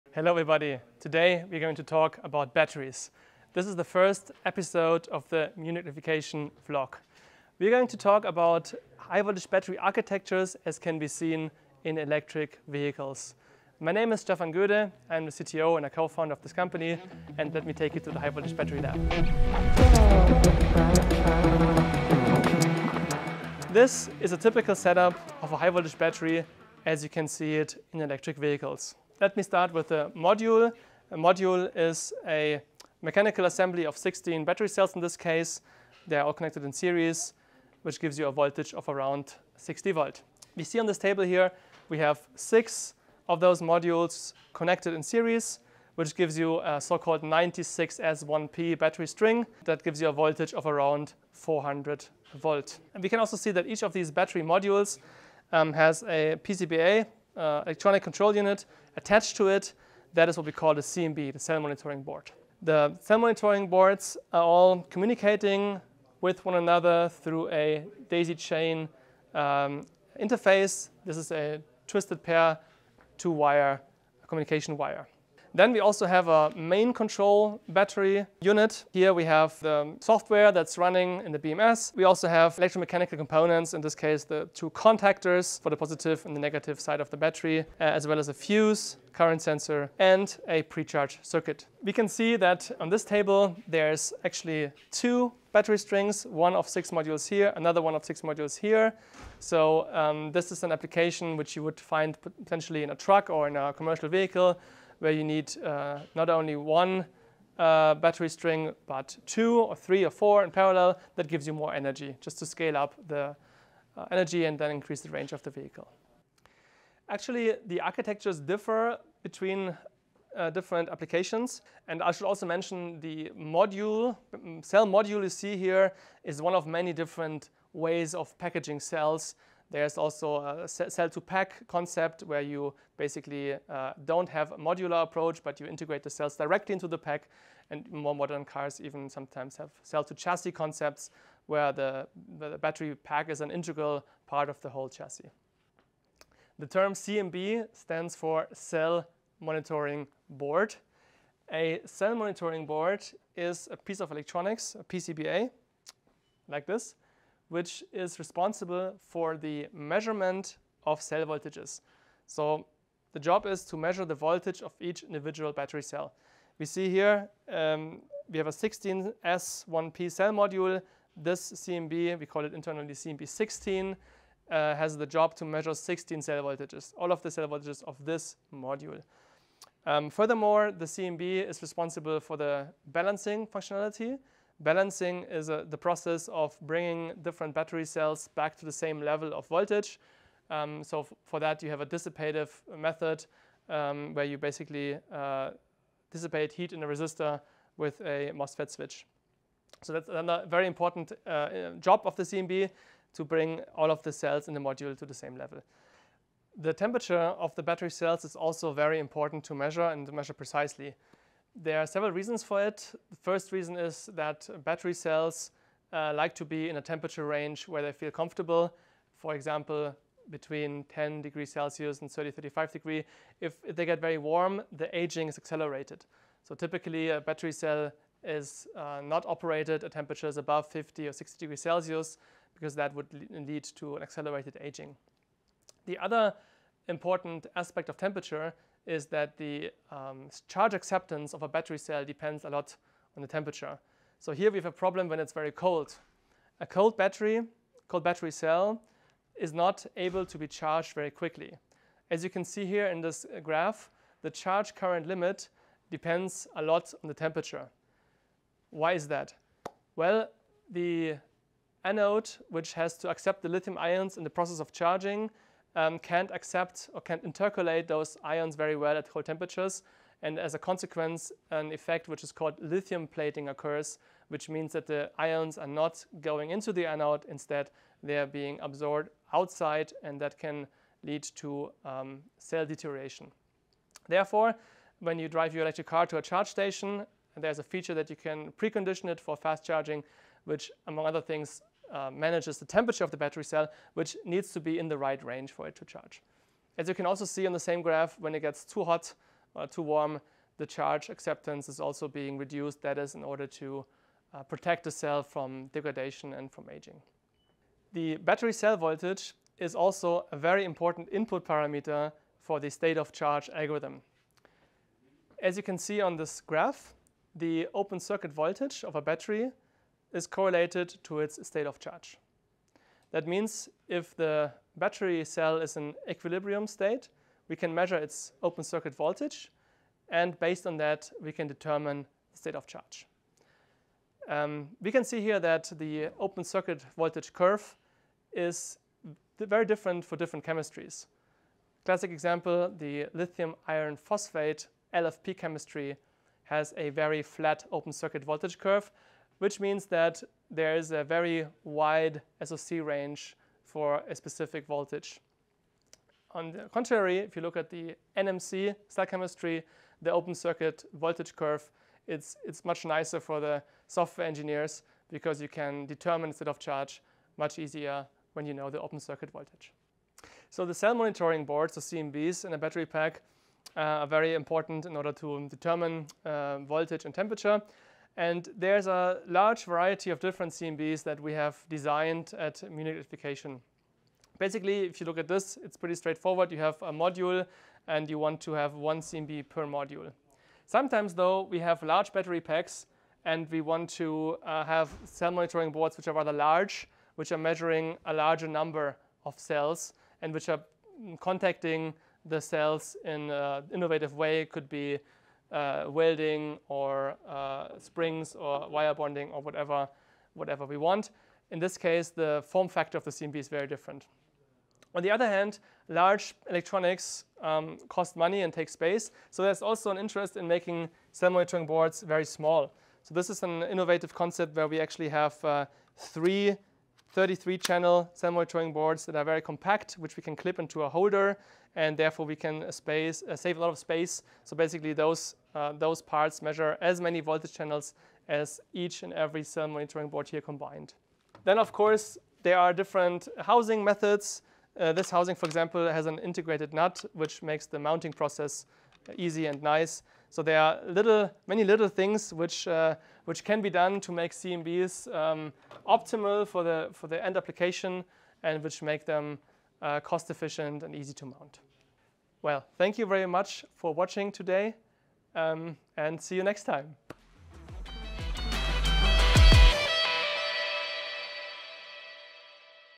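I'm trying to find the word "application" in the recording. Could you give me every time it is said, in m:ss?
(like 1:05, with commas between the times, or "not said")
1:40, 2:00, 7:37.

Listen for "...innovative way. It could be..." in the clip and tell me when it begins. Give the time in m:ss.
6:43.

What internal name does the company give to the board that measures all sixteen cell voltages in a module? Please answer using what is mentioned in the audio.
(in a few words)
CMB16.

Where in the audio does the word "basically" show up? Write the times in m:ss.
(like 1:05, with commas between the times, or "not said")
2:12, 3:14, 6:24, 7:14.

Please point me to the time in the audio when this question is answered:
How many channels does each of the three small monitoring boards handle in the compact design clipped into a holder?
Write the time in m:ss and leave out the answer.
7:07.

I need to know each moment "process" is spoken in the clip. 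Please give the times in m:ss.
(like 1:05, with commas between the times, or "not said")
3:05, 4:24, 7:28.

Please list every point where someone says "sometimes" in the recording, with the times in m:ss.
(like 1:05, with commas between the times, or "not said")
2:19, 6:30.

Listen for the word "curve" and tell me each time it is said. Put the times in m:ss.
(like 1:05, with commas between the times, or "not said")
5:37, 5:48, 6:01.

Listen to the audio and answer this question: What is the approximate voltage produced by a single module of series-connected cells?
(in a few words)
60 volts.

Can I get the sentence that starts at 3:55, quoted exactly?
The other important aspect of temperature is that the um, charge acceptance of a battery cell depends a lot on the temperature.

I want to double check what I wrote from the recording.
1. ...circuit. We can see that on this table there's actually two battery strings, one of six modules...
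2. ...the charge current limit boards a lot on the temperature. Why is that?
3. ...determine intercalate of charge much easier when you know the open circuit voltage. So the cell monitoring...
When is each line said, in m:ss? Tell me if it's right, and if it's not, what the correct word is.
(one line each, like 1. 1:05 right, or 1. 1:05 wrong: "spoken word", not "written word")
1. 1:31 right
2. 4:14 wrong: "depends", not "boards"
3. 6:05 wrong: "state", not "intercalate".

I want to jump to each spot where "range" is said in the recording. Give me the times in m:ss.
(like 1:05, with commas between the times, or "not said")
1:55, 3:37, 4:55, 5:52.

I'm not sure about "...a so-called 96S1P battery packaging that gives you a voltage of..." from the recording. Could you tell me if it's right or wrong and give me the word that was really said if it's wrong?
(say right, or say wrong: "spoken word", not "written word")
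wrong: "string", not "packaging".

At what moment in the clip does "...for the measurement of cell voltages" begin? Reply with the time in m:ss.
2:39.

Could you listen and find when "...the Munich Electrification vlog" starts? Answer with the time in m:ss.
0:05.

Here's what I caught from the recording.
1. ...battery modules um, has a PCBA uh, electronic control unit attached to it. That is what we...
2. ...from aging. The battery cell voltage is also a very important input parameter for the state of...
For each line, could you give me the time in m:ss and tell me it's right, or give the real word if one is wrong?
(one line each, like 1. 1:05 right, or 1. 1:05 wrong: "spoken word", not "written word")
1. 0:54 right
2. 5:06 right.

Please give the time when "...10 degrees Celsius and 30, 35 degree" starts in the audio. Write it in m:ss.
3:40.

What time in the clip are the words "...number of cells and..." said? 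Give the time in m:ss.
6:38.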